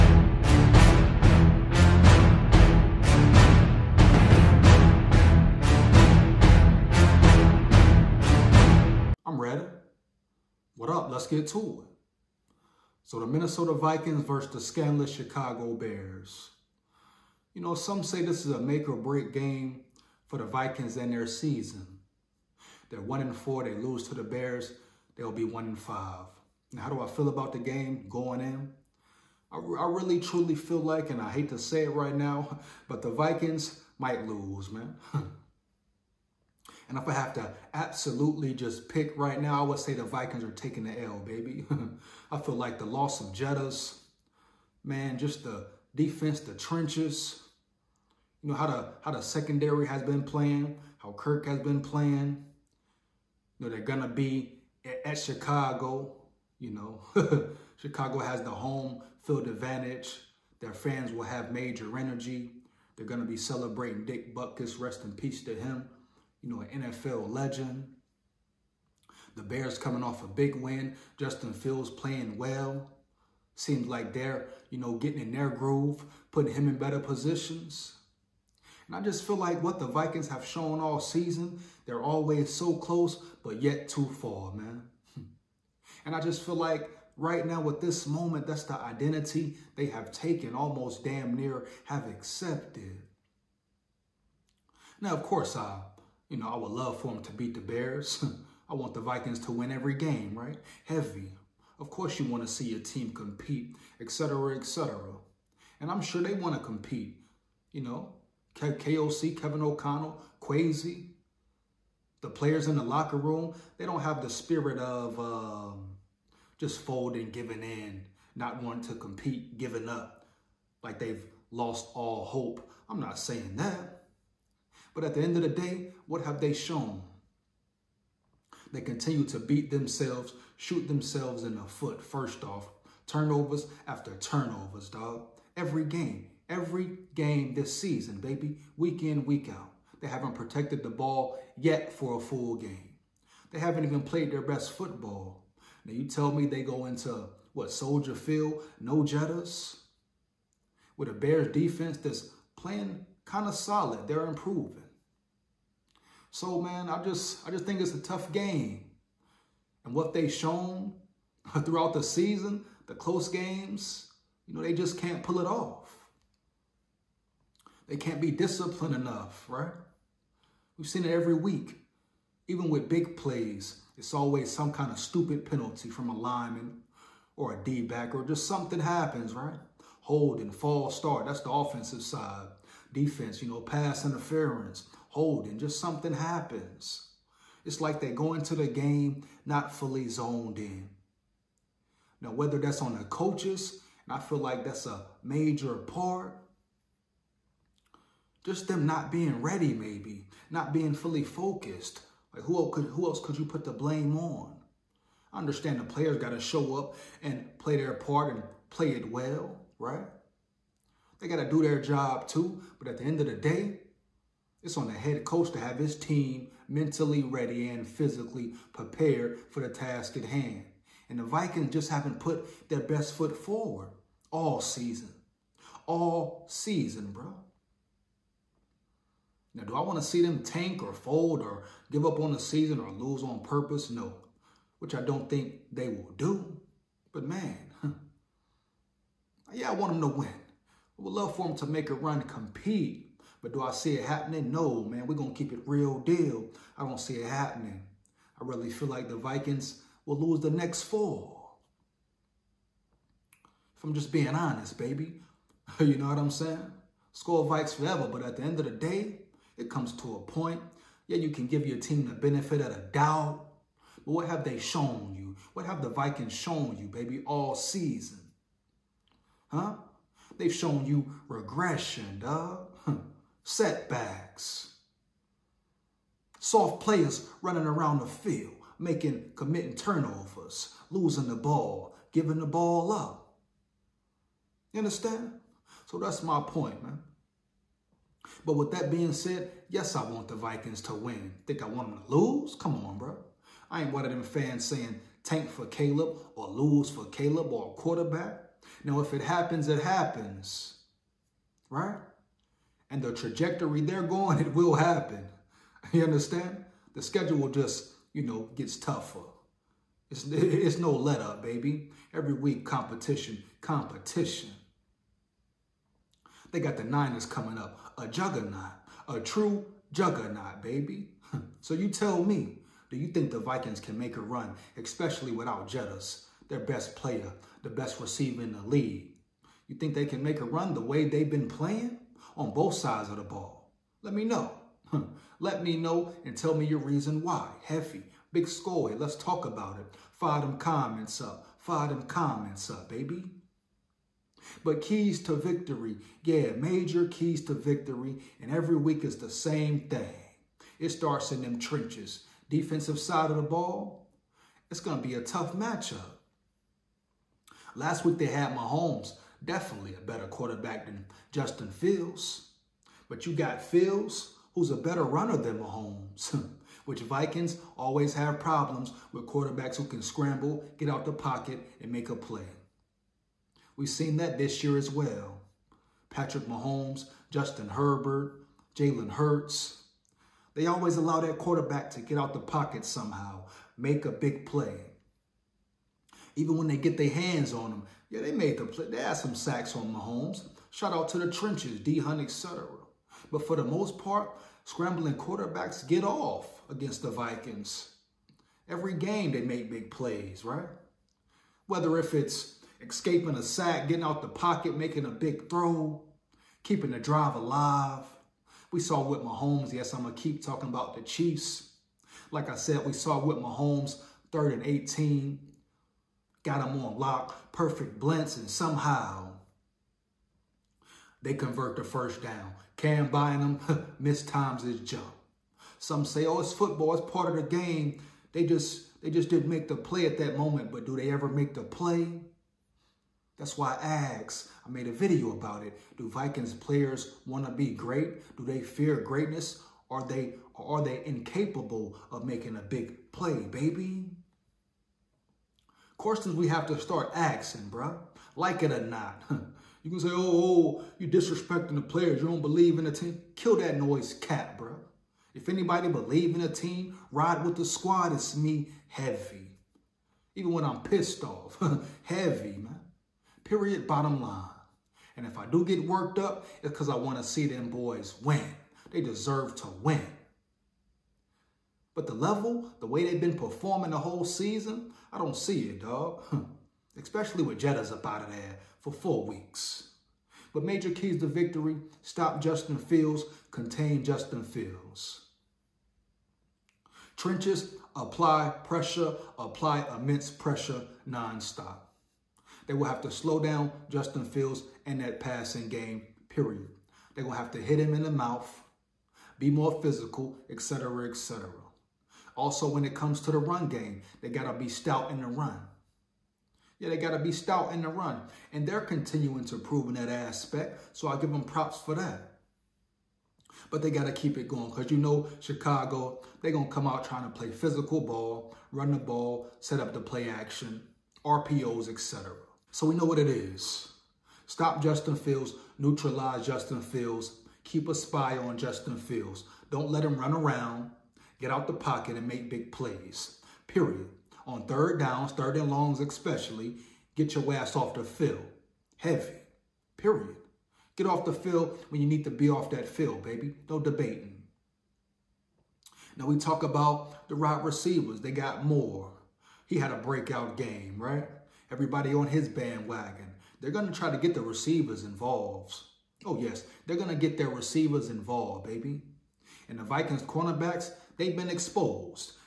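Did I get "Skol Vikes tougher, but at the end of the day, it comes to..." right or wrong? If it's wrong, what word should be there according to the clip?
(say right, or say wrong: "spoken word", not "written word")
wrong: "forever", not "tougher".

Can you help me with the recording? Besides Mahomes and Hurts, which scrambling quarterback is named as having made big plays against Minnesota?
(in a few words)
Justin Herbert.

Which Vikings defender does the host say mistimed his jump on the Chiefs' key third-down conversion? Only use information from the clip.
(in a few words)
Cam Bynum.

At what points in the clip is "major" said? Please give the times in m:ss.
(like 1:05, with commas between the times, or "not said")
1:01, 3:15, 5:46, 8:00.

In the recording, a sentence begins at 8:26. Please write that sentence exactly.
Yeah, they got to be stout in the run.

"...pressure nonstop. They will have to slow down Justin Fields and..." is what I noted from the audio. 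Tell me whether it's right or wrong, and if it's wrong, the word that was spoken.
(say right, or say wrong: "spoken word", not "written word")
right.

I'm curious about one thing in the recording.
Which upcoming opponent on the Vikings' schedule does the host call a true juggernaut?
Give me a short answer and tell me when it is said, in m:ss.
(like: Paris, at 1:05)
49ers, at 5:16.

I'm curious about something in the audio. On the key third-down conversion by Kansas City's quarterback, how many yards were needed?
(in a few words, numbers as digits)
18.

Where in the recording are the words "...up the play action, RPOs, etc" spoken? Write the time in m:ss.
8:39.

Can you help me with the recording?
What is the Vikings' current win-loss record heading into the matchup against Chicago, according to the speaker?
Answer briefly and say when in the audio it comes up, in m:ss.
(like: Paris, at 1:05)
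1 and 4, at 0:23.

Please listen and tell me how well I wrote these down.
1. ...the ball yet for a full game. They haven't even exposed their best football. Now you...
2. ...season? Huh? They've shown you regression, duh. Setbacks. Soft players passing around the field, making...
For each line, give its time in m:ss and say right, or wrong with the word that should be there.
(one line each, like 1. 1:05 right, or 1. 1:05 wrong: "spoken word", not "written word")
1. 2:20 wrong: "played", not "exposed"
2. 4:27 wrong: "running", not "passing".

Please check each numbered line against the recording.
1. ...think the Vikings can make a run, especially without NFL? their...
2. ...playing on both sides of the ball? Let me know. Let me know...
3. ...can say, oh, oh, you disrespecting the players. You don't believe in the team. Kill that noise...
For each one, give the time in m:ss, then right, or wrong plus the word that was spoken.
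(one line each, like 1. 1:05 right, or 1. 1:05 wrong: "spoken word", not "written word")
1. 5:23 wrong: "Jettas", not "NFL"
2. 5:31 right
3. 7:29 right.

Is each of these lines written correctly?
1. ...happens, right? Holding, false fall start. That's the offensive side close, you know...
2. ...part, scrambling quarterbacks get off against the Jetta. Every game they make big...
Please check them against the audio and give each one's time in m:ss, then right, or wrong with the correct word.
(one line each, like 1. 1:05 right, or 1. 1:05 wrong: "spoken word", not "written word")
1. 2:58 wrong: "defense", not "close"
2. 6:33 wrong: "Vikings", not "Jetta".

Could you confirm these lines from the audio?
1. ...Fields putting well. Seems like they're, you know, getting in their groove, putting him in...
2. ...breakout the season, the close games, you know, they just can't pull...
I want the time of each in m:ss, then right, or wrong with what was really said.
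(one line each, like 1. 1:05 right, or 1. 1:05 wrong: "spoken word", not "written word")
1. 1:11 wrong: "playing", not "putting"
2. 2:41 wrong: "throughout", not "breakout".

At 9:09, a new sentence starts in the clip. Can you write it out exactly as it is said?
He had a breakout game, right?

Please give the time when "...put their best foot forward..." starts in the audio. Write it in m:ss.
3:42.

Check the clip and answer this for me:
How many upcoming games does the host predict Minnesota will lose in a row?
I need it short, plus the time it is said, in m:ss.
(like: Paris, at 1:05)
4, at 4:10.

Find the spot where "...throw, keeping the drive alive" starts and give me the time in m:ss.
6:45.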